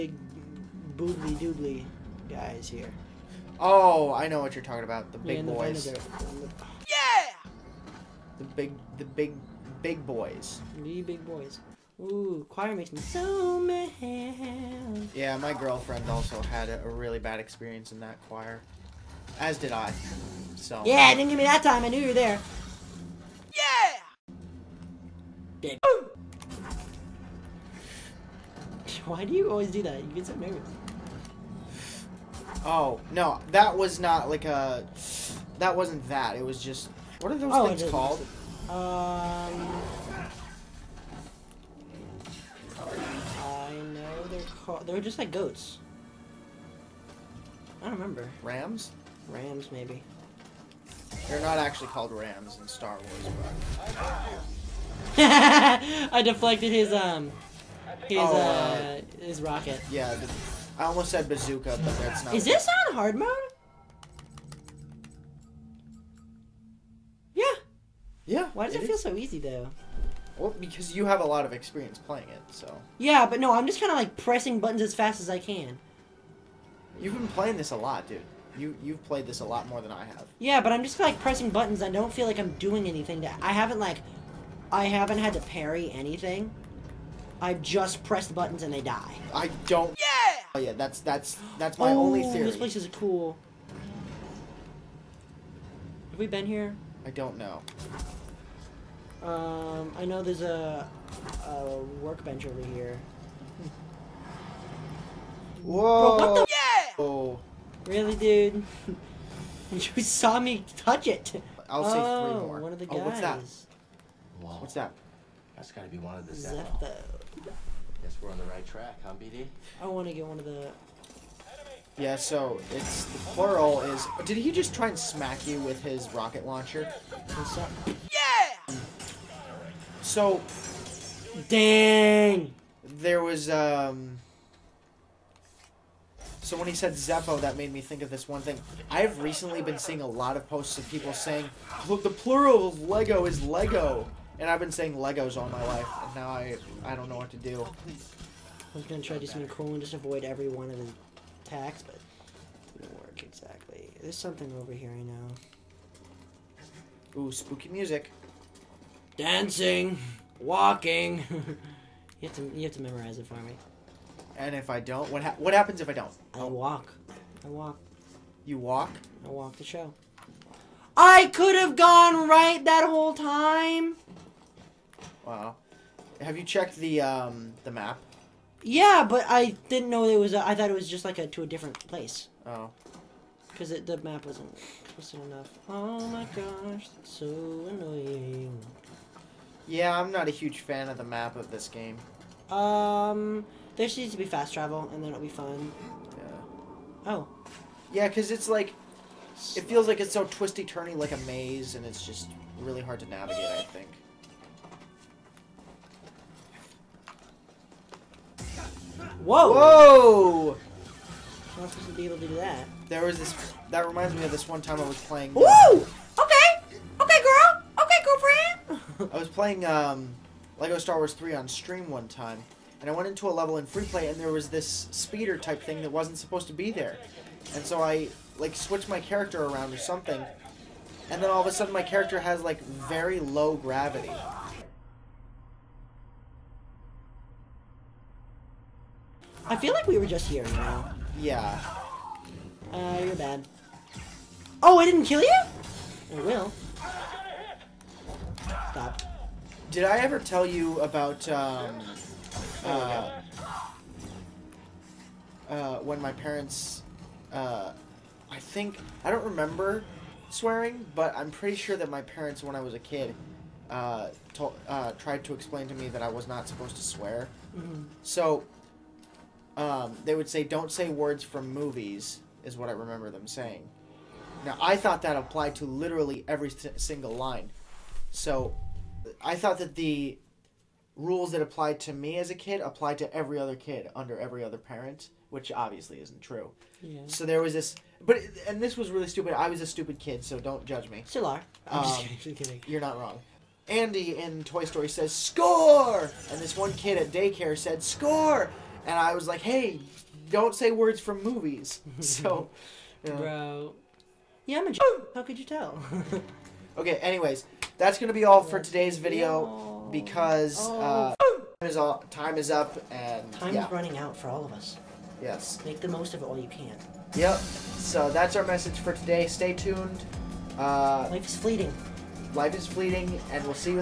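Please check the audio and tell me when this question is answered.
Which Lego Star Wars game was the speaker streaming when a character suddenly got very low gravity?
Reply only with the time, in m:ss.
3:40.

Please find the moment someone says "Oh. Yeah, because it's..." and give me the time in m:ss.
3:17.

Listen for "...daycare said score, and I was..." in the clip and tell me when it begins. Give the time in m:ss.
4:57.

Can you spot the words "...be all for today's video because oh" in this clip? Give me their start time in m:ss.
5:08.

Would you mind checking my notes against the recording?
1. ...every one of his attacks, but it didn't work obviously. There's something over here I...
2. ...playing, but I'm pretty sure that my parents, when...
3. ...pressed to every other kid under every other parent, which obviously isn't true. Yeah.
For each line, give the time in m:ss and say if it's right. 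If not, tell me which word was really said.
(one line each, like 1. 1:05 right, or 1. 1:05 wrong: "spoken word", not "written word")
1. 2:30 wrong: "exactly", not "obviously"
2. 4:20 wrong: "swearing", not "playing"
3. 4:42 wrong: "applied", not "pressed".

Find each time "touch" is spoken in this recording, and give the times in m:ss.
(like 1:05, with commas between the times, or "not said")
1:50.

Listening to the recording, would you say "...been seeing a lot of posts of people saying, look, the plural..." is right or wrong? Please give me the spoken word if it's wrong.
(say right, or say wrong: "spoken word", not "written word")
right.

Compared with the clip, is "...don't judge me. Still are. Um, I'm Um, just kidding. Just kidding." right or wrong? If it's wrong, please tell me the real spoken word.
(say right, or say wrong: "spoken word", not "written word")
right.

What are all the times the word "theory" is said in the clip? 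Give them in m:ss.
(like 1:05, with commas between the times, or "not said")
1:32.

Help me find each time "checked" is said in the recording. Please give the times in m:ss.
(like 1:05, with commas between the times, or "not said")
2:56.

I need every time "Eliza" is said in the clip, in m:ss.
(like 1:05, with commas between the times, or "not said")
not said.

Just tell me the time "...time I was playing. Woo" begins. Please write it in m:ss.
3:34.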